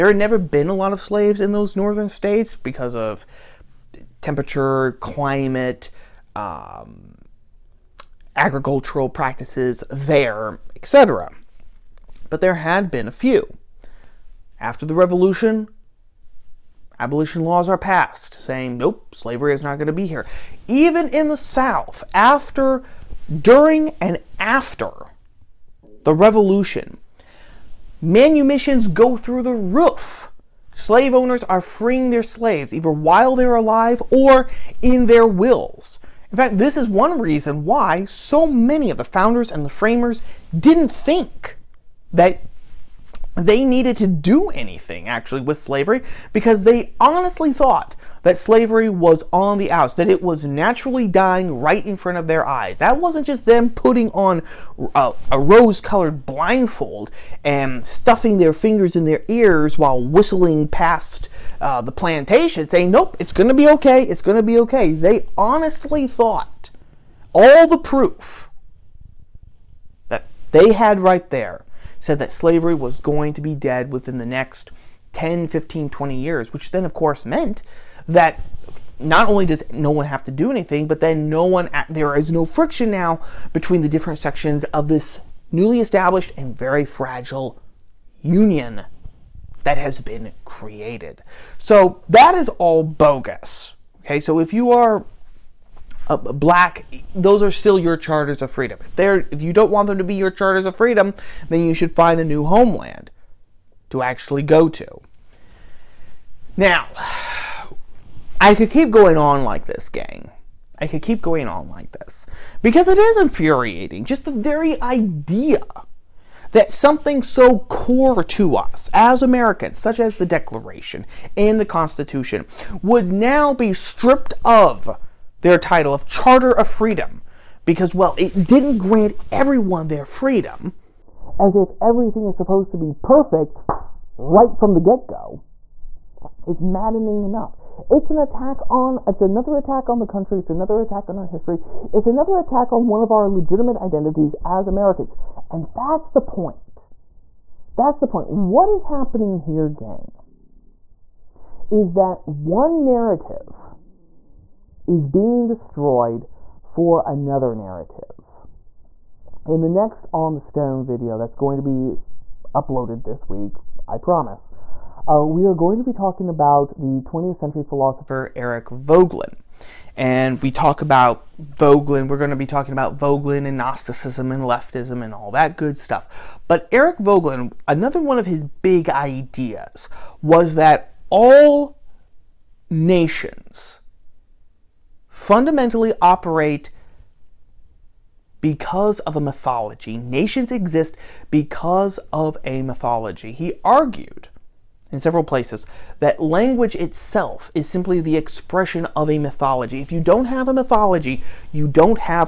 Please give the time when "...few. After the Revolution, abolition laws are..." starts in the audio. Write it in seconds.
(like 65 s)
13 s.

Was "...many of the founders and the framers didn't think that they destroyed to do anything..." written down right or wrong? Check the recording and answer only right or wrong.
wrong.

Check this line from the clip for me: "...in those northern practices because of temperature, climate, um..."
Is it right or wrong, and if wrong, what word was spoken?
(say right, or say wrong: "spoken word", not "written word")
wrong: "states", not "practices".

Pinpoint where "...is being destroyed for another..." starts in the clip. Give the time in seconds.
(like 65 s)
154 s.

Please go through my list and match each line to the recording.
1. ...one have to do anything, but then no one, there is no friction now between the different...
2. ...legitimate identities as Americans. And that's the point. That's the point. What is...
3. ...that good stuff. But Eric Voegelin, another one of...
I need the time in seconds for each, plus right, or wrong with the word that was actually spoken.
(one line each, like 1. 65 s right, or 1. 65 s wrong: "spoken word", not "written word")
1. 79 s right
2. 143 s right
3. 175 s right.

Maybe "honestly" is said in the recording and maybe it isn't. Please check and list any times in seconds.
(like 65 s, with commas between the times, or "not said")
46 s, 65 s.